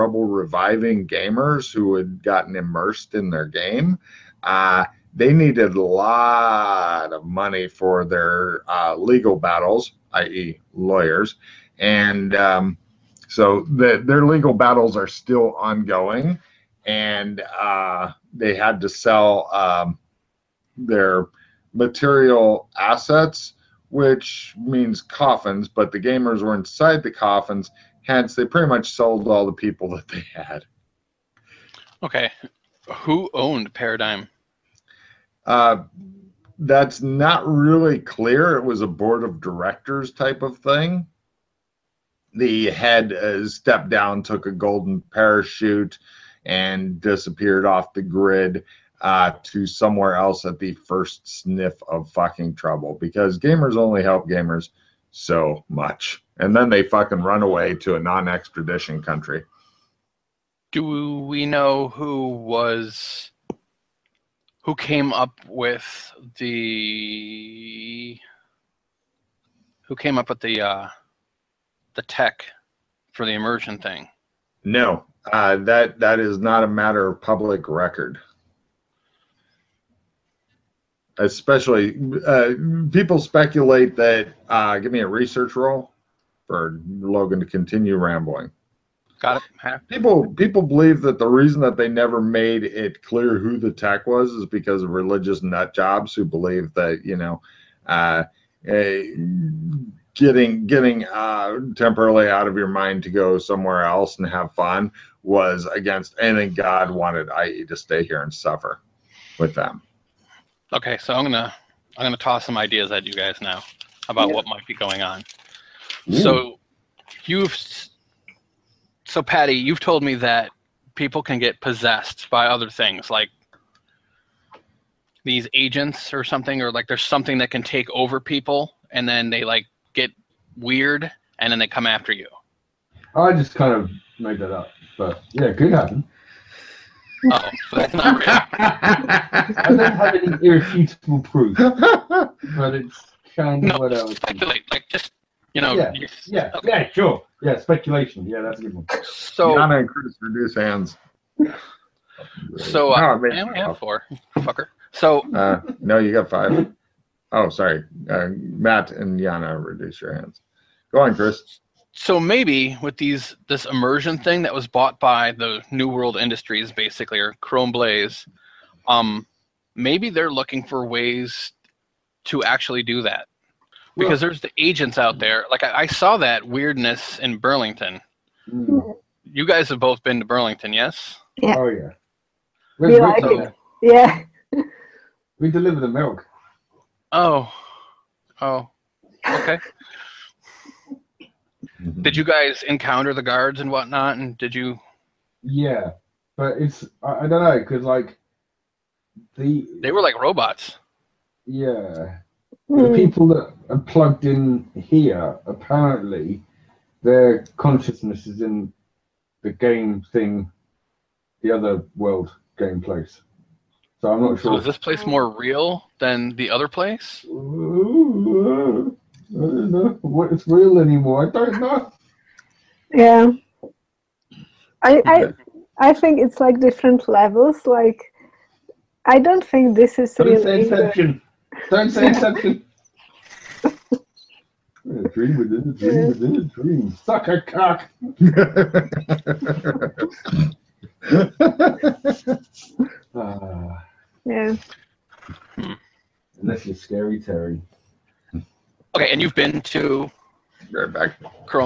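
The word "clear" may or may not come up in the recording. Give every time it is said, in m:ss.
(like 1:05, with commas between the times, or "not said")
0:37, 1:33.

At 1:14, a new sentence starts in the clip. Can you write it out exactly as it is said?
No, uh, that that is not a matter of public record.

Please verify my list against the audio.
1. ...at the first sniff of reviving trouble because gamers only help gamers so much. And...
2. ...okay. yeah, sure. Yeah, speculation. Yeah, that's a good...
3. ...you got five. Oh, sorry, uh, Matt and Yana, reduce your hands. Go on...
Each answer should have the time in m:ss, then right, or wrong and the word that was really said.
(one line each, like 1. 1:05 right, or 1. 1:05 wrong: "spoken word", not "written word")
1. 0:50 wrong: "fucking", not "reviving"
2. 2:26 right
3. 2:35 right.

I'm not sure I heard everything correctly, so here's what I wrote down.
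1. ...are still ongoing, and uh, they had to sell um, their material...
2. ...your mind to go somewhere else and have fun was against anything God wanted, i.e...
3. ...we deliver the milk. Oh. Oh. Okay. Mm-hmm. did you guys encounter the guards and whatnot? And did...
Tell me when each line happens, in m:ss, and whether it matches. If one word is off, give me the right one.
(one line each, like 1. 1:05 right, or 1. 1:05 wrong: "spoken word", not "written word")
1. 0:14 right
2. 1:42 right
3. 3:05 right.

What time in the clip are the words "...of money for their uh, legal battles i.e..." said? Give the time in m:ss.
0:07.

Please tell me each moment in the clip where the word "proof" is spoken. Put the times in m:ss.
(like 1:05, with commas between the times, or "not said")
2:21.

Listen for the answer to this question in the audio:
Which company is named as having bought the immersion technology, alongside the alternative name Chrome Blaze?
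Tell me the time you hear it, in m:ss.
2:45.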